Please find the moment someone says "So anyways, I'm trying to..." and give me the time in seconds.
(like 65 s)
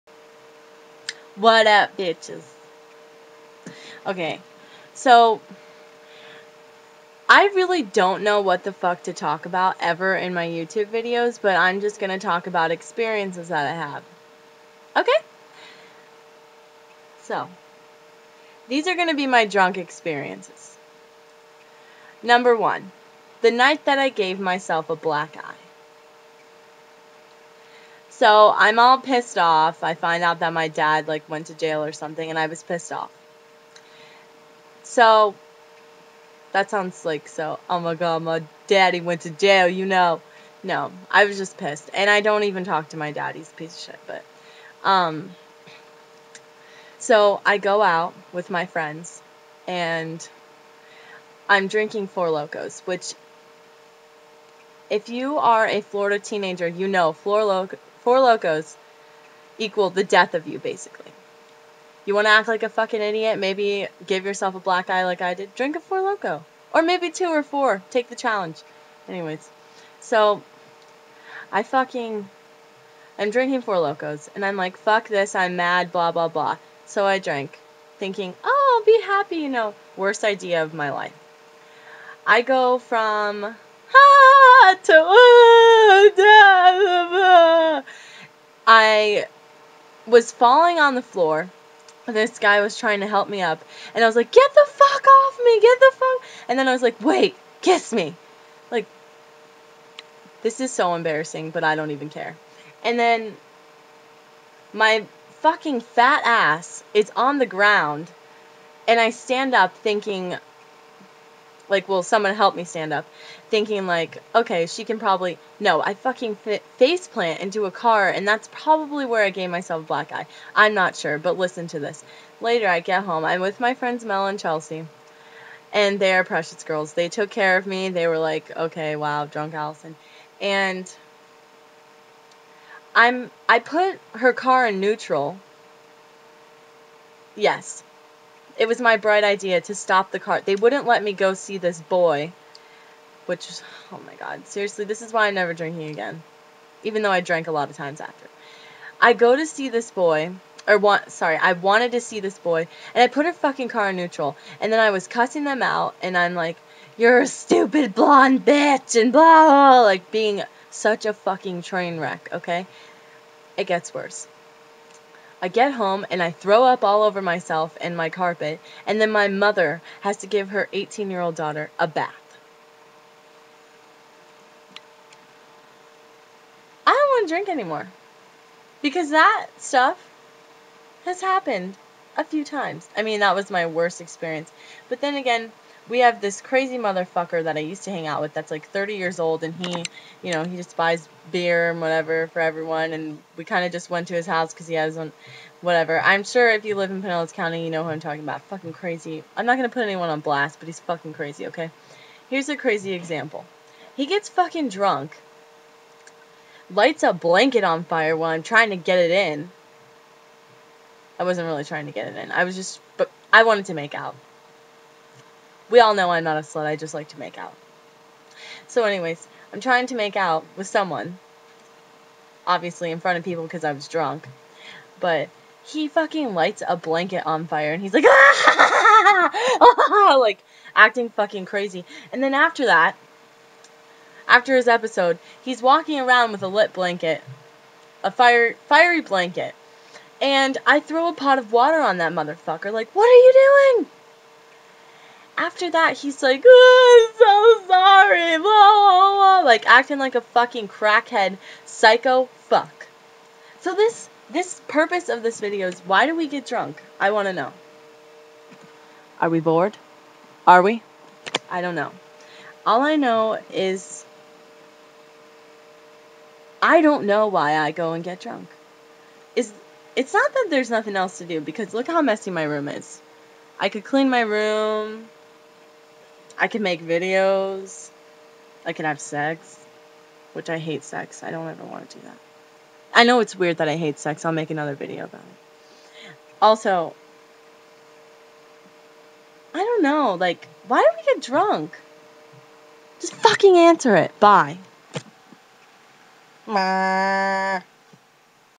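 218 s.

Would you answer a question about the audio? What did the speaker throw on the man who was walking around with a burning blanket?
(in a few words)
A pot of water.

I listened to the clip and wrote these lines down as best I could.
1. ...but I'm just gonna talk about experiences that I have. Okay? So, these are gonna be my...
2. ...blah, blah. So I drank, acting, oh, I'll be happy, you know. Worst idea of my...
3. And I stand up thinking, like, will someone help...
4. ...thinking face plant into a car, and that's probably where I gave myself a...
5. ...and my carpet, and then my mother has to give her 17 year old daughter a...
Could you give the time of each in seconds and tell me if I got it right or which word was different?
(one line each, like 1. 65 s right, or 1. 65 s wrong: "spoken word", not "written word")
1. 11 s right
2. 76 s wrong: "thinking", not "acting"
3. 108 s right
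4. 115 s wrong: "fucking", not "thinking"
5. 167 s wrong: "18", not "17".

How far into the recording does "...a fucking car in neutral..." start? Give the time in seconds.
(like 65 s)
153 s.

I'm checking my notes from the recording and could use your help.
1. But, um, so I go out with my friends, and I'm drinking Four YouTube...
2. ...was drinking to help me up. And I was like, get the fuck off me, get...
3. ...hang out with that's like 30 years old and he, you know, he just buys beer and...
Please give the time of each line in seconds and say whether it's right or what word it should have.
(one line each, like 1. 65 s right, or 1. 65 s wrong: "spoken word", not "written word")
1. 44 s wrong: "Locos", not "YouTube"
2. 92 s wrong: "trying", not "drinking"
3. 187 s right.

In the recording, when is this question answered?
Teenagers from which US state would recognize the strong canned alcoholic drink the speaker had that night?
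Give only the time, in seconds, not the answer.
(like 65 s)
55 s.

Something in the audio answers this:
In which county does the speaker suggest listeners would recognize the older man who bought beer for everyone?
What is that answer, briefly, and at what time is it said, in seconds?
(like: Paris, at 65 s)
Pinellas County, at 197 s.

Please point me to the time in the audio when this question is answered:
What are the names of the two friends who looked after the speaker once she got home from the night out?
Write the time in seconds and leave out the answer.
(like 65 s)
124 s.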